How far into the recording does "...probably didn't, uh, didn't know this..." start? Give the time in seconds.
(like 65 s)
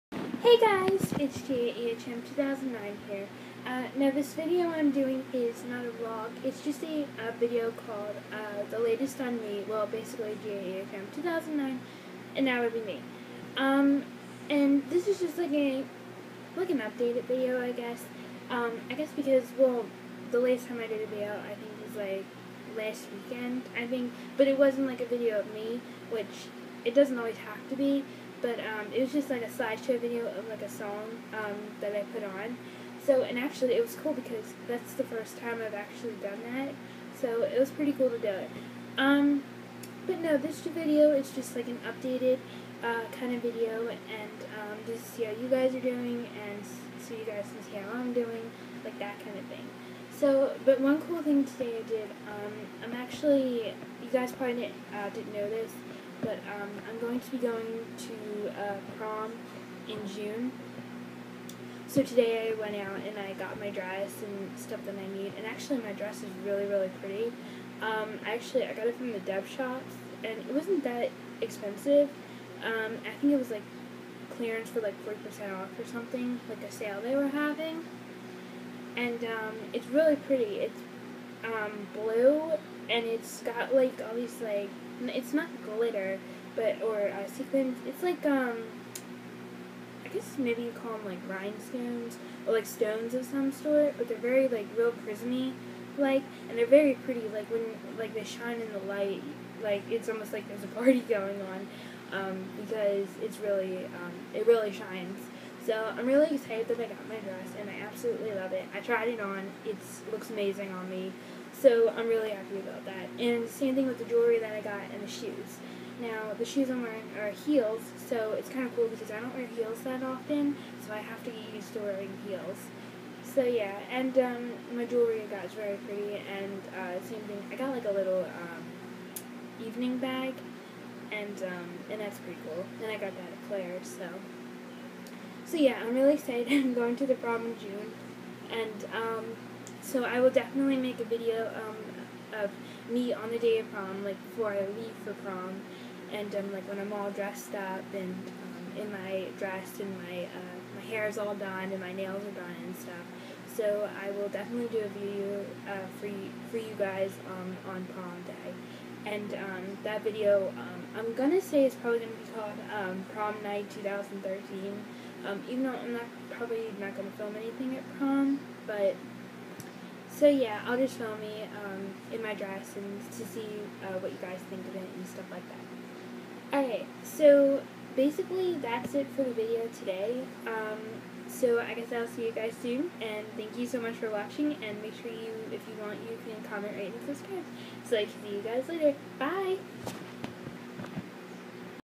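54 s.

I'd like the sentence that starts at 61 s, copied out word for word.
So today I went out and I got my dress and stuff that I need.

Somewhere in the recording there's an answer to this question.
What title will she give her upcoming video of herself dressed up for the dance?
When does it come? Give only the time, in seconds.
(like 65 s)
163 s.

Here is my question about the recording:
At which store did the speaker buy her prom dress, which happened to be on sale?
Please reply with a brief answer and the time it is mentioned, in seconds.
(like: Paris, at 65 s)
Deb shop, at 69 s.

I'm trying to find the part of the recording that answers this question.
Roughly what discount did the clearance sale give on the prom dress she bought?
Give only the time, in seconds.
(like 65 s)
75 s.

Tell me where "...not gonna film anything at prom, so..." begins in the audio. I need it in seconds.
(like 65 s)
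166 s.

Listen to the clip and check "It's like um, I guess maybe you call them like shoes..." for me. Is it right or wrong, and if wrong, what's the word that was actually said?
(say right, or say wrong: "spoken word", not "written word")
wrong: "rhinestones", not "shoes".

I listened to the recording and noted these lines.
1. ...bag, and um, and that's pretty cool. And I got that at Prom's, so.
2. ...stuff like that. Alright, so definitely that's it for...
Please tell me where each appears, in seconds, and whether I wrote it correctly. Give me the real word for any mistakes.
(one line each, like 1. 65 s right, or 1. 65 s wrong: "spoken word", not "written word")
1. 129 s wrong: "Claire", not "Prom"
2. 175 s wrong: "basically", not "definitely".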